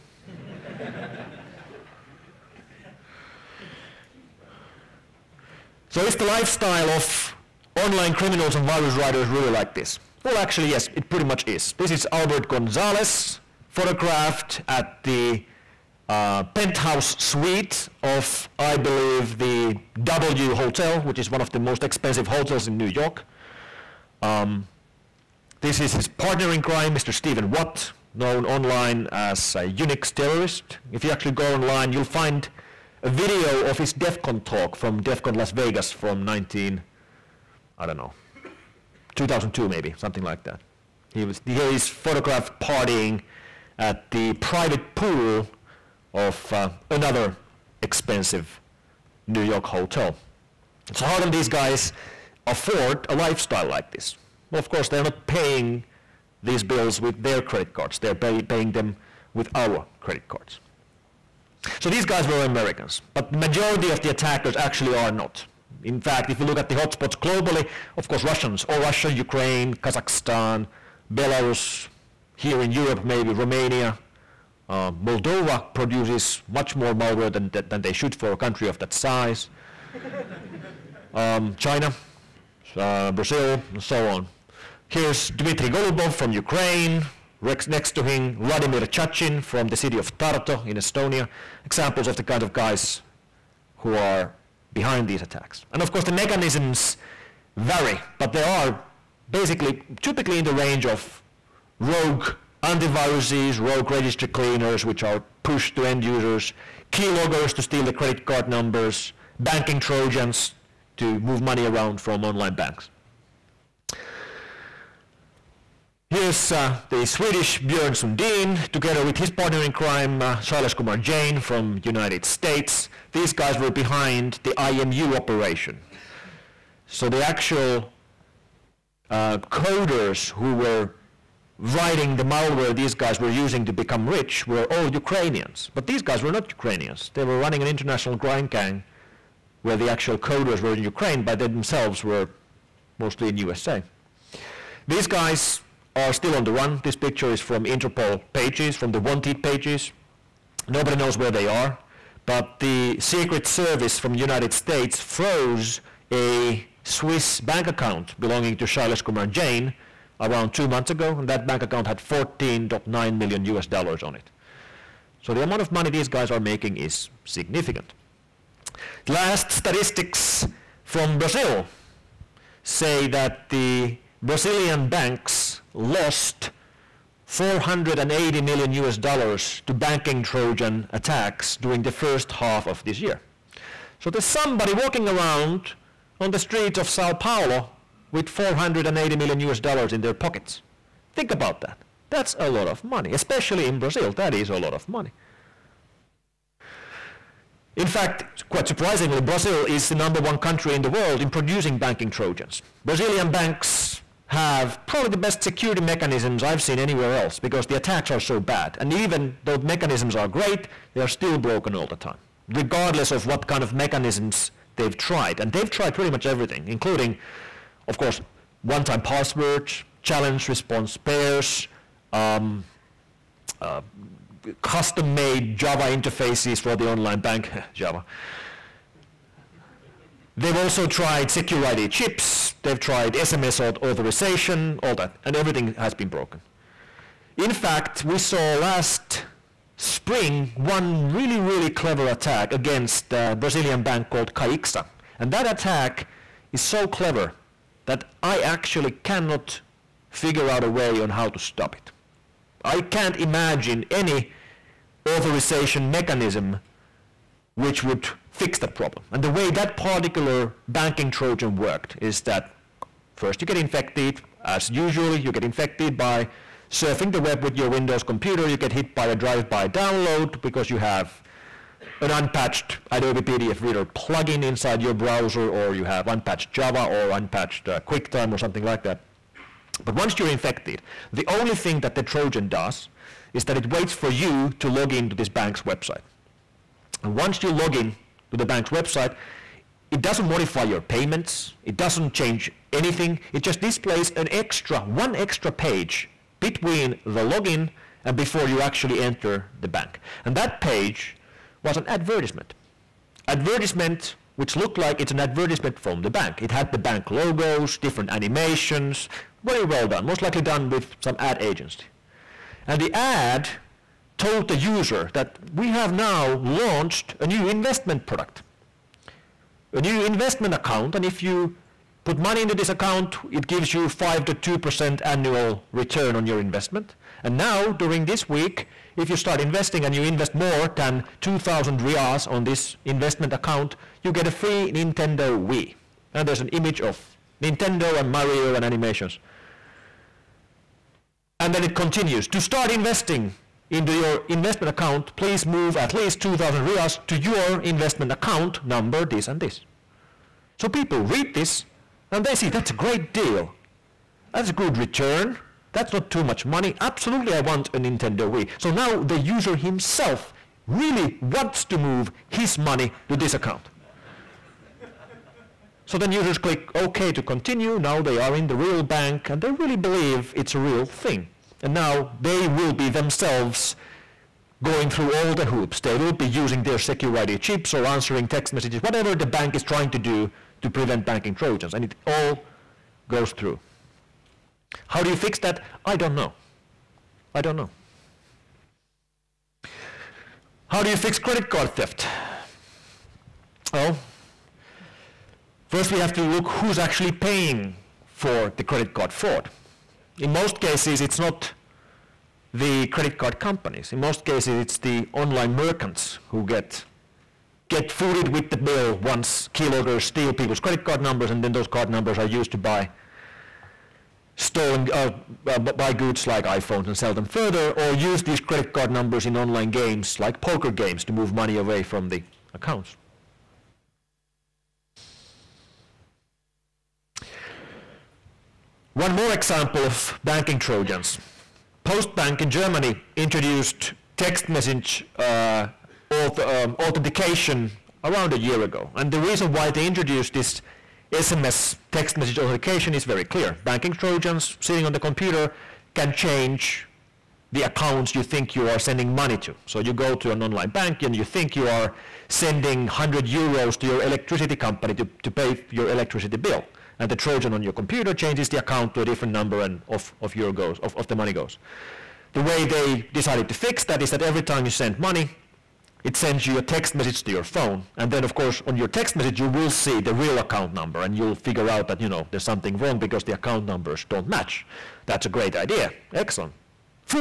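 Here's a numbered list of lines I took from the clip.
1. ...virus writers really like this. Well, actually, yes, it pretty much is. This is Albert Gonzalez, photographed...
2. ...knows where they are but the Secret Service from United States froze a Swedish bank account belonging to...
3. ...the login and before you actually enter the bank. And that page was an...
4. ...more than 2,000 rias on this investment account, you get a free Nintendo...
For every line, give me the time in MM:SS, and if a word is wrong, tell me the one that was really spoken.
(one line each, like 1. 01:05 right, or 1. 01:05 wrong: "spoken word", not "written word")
1. 00:08 right
2. 02:30 wrong: "Swiss", not "Swedish"
3. 04:57 right
4. 05:30 right.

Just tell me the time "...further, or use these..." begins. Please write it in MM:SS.
06:57.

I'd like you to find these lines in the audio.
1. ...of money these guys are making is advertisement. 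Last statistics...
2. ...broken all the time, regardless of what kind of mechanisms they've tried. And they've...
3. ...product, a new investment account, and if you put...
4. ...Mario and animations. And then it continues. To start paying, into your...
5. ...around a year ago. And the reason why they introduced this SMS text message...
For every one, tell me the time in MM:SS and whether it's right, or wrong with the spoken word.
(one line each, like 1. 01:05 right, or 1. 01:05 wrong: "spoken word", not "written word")
1. 02:45 wrong: "significant", not "advertisement"
2. 03:31 right
3. 05:18 right
4. 05:38 wrong: "investing", not "paying"
5. 07:18 right.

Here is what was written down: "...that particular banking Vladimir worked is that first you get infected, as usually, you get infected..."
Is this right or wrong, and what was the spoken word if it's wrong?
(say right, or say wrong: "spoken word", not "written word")
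wrong: "Trojan", not "Vladimir".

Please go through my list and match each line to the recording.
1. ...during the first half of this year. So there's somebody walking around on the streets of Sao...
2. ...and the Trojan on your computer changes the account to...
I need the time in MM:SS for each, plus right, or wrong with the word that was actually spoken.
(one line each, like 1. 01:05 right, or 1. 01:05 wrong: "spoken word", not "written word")
1. 03:01 right
2. 07:36 right.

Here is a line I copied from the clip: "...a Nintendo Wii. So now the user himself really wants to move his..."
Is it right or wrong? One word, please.
right.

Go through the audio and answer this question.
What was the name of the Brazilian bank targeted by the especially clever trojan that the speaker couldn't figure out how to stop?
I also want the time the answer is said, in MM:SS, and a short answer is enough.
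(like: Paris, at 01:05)
Caixa, at 04:04.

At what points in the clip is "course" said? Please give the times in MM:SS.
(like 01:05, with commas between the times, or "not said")
00:54, 01:08, 01:35, 03:37, 07:48.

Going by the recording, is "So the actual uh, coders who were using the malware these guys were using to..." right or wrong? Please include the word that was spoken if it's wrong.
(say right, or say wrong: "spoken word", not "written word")
wrong: "writing", not "using".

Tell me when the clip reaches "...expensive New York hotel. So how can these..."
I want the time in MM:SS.
00:47.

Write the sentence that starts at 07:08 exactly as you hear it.
One more example of banking Trojans.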